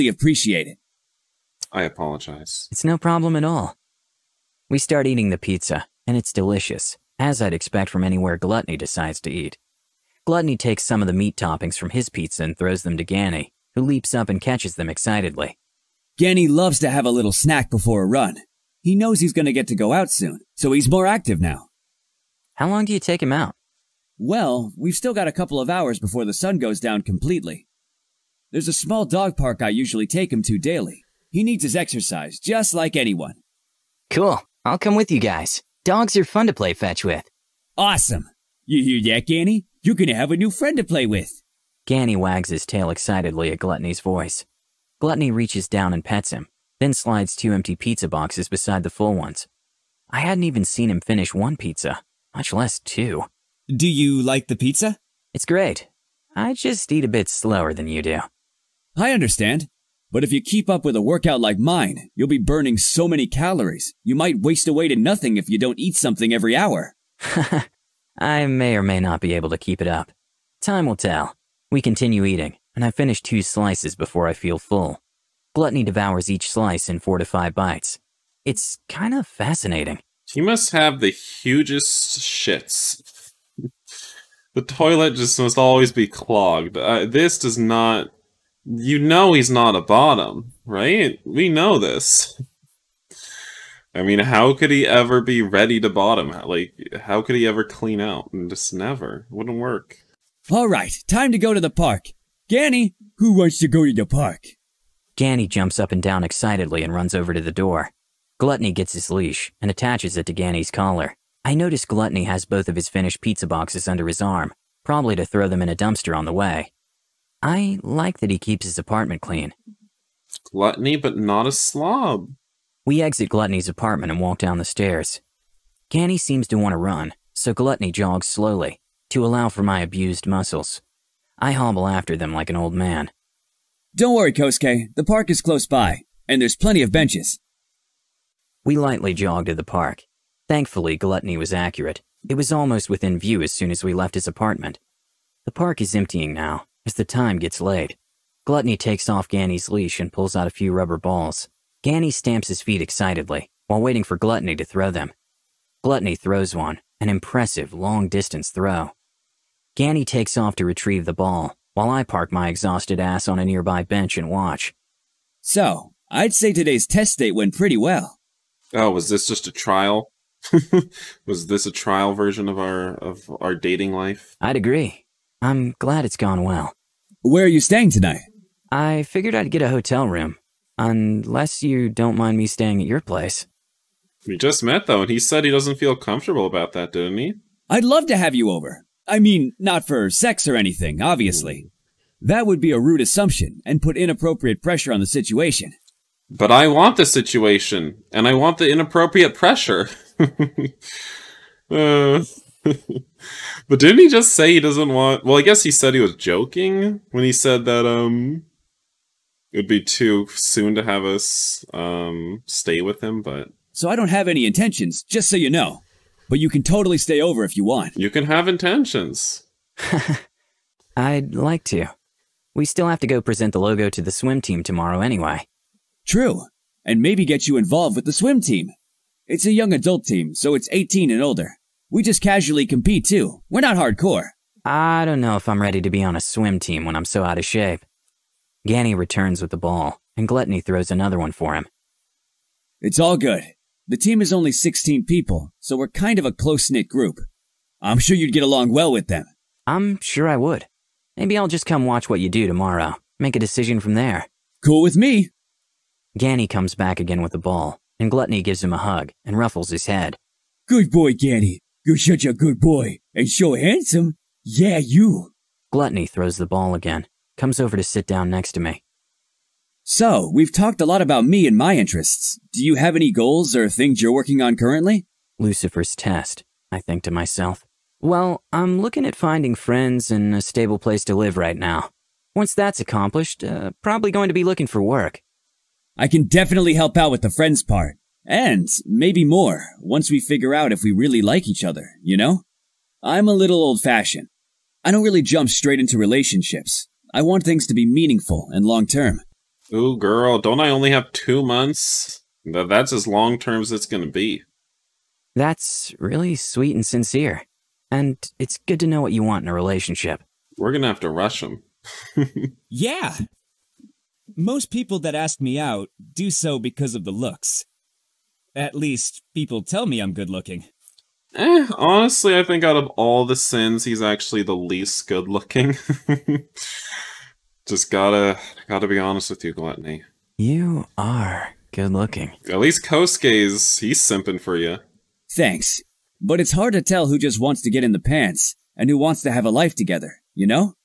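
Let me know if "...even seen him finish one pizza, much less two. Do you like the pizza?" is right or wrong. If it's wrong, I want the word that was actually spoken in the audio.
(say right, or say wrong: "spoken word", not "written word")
right.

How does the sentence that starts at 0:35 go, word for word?
Dogs are fun to play fetch with.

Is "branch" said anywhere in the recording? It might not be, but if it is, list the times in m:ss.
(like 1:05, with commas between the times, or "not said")
not said.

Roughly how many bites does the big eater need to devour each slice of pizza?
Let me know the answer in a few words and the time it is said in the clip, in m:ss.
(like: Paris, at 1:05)
4 to 5, at 1:17.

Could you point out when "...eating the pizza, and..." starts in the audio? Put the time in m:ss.
0:05.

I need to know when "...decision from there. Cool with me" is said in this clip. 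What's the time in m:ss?
4:13.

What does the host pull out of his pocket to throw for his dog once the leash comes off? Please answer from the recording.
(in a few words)
Rubber balls.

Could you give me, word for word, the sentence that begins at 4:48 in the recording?
And maybe more, once we figure out if we really like each other, you know?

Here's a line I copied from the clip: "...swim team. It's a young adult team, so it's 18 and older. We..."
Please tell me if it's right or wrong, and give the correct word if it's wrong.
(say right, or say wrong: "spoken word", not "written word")
right.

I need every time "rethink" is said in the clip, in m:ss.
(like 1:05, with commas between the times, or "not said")
not said.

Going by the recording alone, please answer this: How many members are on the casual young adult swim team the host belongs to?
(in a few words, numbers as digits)
16.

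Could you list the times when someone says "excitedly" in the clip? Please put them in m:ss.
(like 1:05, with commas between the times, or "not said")
0:14, 0:42, 1:46, 2:32.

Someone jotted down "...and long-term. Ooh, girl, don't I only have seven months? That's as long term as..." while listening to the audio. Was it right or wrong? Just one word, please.
wrong.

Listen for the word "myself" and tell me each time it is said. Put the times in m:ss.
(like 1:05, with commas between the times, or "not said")
4:37.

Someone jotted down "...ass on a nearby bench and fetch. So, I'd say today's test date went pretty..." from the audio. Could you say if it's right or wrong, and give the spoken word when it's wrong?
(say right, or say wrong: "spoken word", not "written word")
wrong: "watch", not "fetch".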